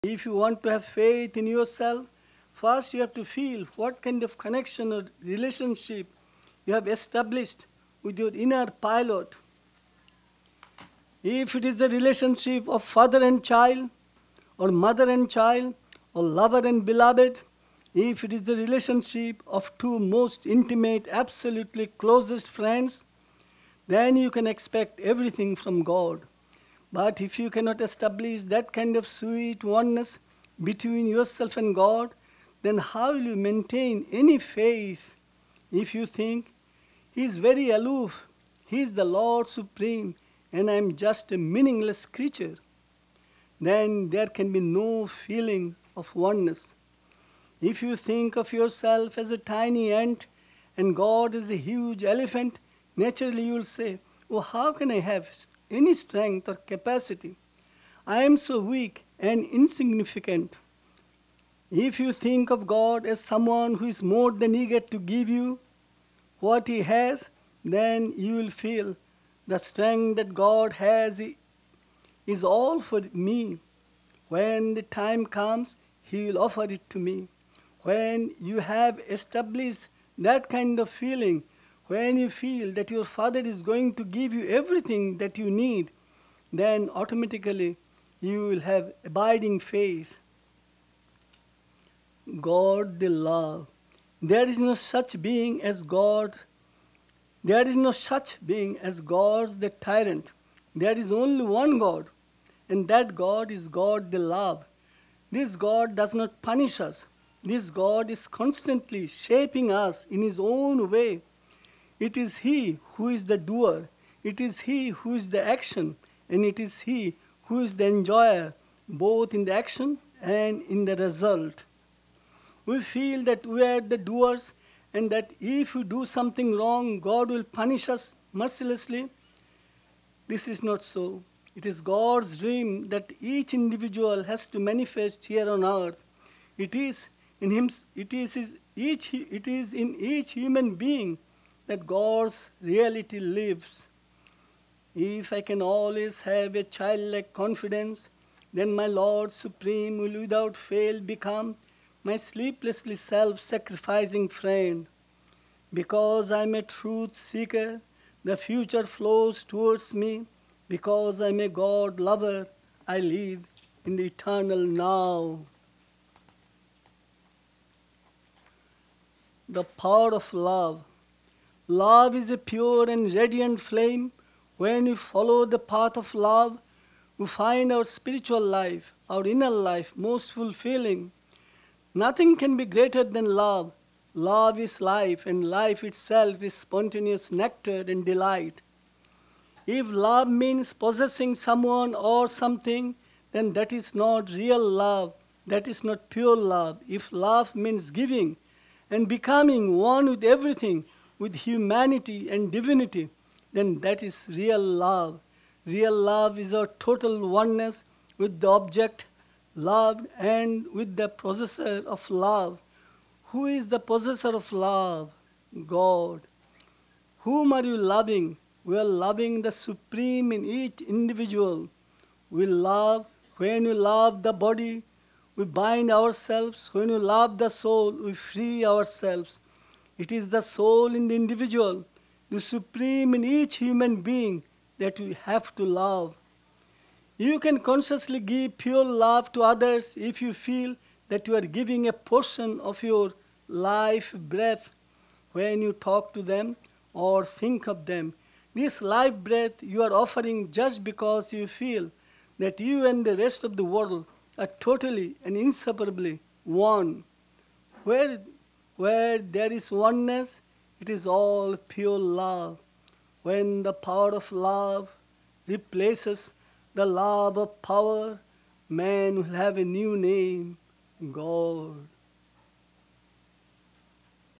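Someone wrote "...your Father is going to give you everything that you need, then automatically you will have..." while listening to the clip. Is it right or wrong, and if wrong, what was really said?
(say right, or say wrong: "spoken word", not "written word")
right.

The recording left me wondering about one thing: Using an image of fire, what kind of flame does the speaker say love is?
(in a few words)
A pure and radiant flame.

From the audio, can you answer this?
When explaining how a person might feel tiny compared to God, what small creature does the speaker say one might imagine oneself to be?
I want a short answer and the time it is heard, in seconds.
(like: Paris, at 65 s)
A tiny ant, at 49 s.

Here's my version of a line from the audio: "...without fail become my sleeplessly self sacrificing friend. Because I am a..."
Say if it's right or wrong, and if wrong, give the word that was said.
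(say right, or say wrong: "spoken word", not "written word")
right.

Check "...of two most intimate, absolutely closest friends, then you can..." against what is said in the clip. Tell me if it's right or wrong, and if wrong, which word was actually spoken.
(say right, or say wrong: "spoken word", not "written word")
right.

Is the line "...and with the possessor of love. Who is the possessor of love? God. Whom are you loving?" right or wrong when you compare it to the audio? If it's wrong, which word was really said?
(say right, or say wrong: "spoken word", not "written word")
right.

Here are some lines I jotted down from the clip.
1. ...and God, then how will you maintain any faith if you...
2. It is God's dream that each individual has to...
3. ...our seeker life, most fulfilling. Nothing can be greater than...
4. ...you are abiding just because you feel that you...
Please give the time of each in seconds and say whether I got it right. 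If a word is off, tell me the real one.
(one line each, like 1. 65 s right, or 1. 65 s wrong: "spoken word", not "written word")
1. 31 s right
2. 131 s right
3. 179 s wrong: "inner", not "seeker"
4. 249 s wrong: "offering", not "abiding".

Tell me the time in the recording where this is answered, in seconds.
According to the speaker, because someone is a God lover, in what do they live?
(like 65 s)
163 s.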